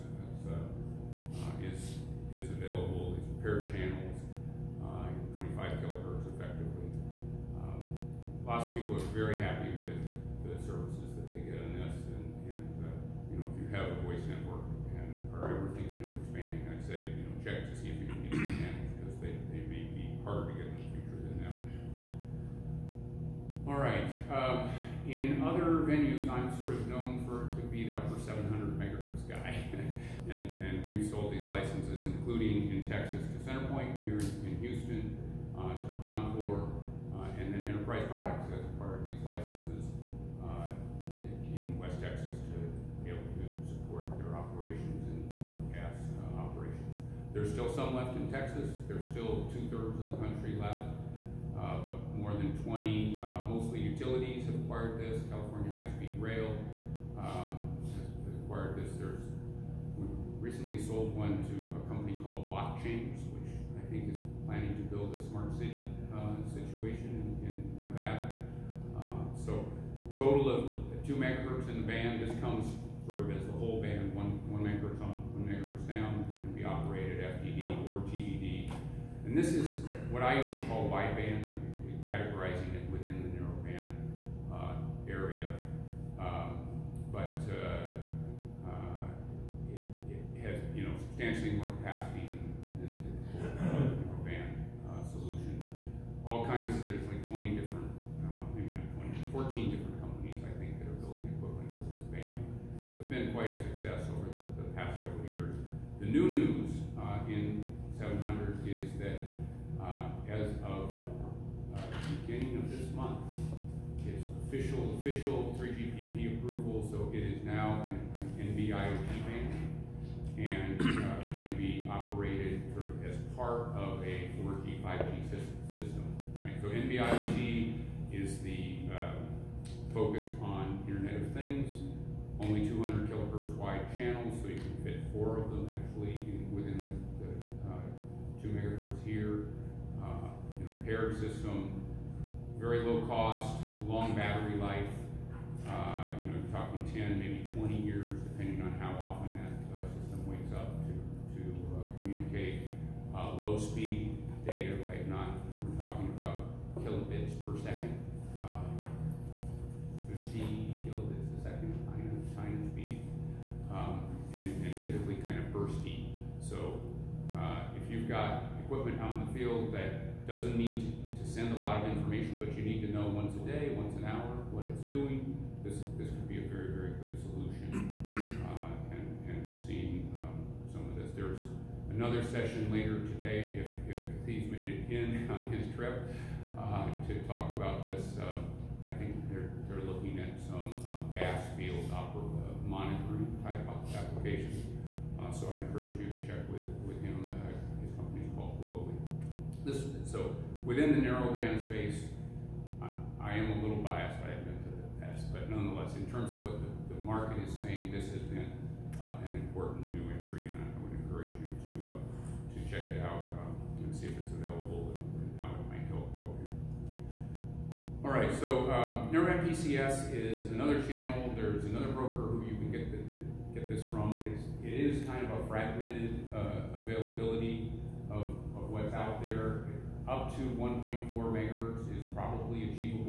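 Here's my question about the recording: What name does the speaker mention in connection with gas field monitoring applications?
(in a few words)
Blowy.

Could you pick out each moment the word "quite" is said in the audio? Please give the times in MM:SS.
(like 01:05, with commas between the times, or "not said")
01:43.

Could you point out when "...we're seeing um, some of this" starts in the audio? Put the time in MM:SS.
02:59.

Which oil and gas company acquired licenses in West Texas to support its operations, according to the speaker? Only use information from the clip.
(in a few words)
Enterprise Products.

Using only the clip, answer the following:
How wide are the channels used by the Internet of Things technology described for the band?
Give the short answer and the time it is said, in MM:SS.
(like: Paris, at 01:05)
200 kilohertz, at 02:12.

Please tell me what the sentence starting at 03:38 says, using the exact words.
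All right, so um, NeurMap is another channel.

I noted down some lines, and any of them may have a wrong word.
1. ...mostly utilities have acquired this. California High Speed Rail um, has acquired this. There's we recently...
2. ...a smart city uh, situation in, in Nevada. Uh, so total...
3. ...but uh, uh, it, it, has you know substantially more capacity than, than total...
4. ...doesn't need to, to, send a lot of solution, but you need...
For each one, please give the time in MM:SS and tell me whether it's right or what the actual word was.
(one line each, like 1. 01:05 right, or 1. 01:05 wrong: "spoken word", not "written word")
1. 00:53 right
2. 01:05 right
3. 01:27 wrong: "typical", not "total"
4. 02:50 wrong: "information", not "solution".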